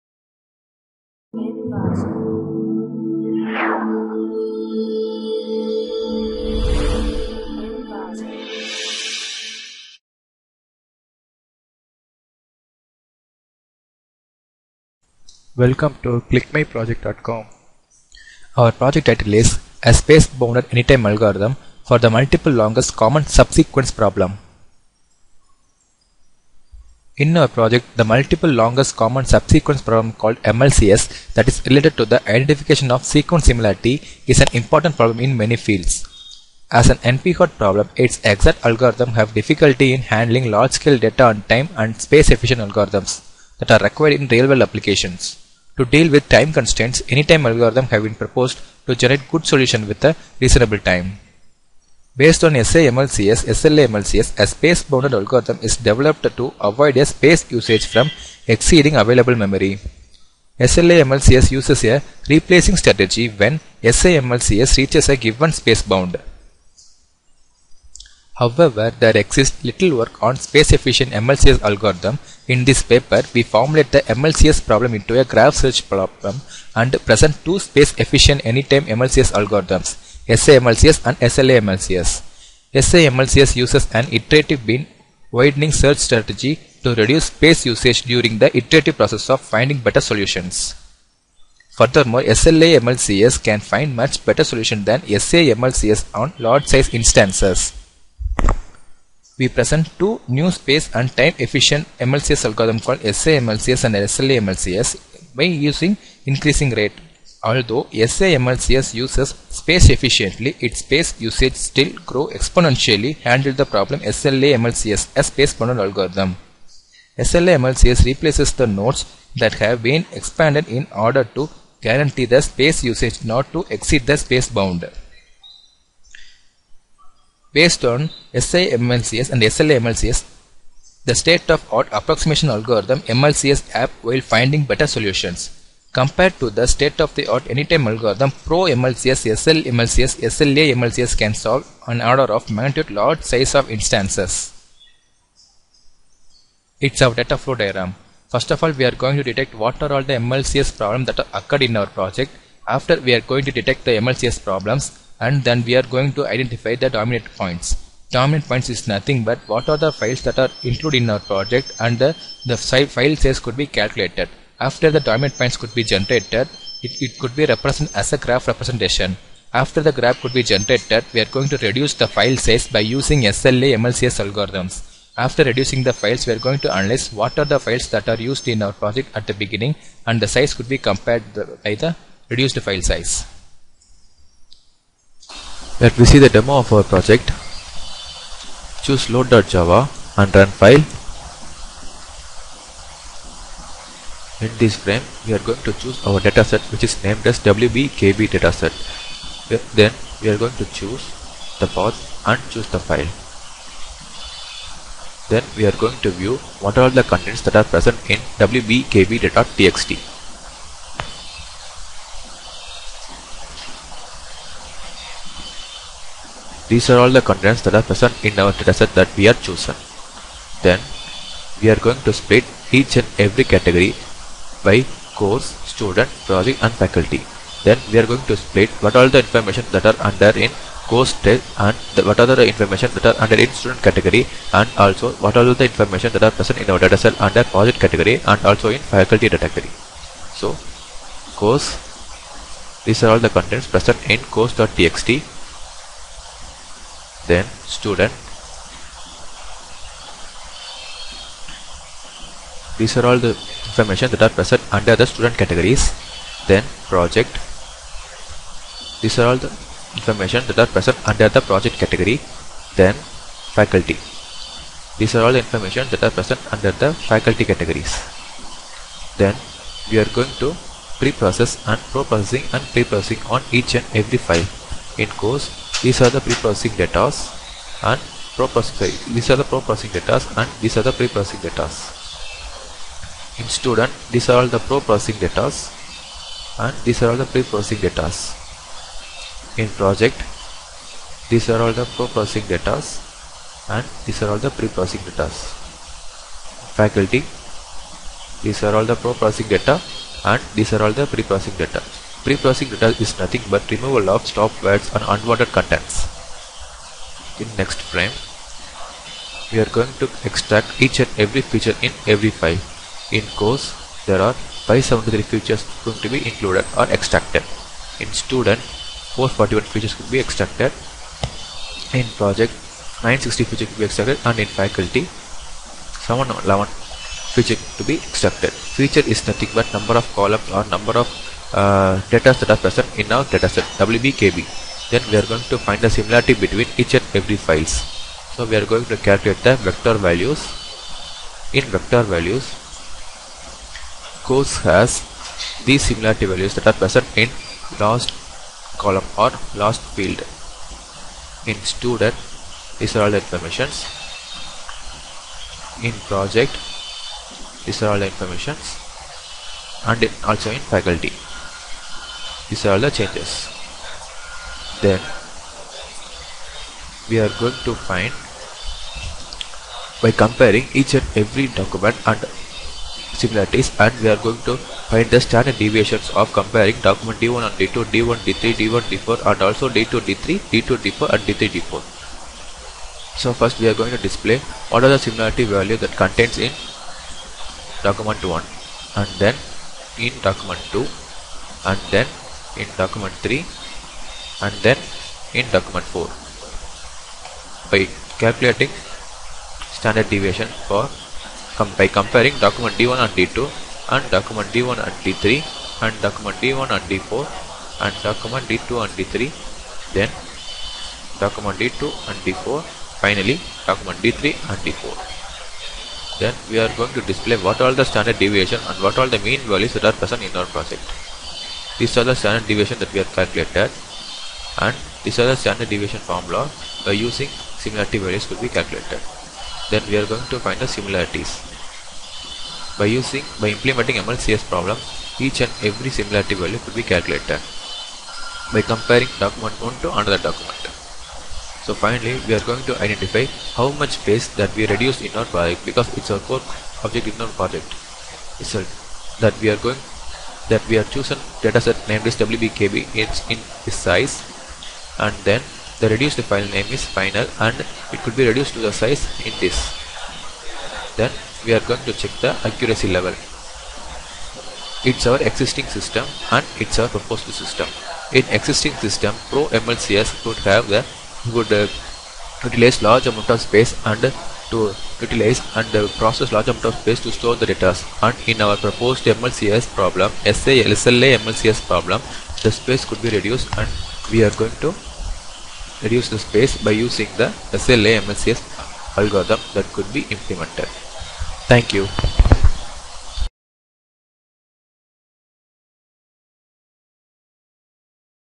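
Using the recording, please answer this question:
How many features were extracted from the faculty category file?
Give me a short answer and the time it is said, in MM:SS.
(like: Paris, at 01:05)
711, at 05:26.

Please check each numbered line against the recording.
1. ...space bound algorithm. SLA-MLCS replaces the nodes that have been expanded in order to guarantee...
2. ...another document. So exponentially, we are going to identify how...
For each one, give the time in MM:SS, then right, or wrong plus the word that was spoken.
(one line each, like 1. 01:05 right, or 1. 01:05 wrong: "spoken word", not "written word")
1. 01:55 right
2. 07:19 wrong: "finally", not "exponentially".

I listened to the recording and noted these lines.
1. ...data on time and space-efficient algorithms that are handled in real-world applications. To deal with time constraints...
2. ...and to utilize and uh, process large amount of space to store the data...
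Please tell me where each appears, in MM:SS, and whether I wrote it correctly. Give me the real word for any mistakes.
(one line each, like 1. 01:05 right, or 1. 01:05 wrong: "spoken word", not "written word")
1. 00:40 wrong: "required", not "handled"
2. 07:53 right.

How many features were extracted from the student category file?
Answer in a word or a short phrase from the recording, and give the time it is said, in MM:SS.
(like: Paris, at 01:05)
441, at 05:19.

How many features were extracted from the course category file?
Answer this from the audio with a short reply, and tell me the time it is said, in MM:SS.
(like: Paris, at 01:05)
573, at 05:14.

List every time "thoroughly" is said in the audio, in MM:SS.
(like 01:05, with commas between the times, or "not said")
not said.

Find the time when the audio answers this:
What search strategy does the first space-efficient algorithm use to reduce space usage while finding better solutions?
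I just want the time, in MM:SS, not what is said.
01:24.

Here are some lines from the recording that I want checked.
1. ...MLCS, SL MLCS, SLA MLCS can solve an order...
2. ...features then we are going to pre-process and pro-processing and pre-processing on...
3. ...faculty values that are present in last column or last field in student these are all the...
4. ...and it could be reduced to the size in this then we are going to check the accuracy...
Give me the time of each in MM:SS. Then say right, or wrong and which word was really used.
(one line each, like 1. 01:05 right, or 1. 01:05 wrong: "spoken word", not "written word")
1. 02:18 right
2. 04:27 wrong: "categories", not "features"
3. 05:45 wrong: "similarity", not "faculty"
4. 07:37 right.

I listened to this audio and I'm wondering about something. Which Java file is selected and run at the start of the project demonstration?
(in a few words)
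load.java.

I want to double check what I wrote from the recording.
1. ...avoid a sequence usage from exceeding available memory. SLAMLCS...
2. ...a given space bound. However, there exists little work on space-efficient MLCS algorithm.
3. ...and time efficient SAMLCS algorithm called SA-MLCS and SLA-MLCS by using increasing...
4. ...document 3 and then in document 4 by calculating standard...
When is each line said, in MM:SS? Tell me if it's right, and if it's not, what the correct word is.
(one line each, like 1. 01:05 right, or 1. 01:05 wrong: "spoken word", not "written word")
1. 00:56 wrong: "space", not "sequence"
2. 01:05 right
3. 01:40 wrong: "MLCS", not "SAMLCS"
4. 06:32 right.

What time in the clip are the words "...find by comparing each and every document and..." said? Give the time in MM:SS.
06:07.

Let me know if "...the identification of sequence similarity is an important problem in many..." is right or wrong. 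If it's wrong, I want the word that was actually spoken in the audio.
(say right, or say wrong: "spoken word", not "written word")
right.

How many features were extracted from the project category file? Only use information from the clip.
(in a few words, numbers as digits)
960.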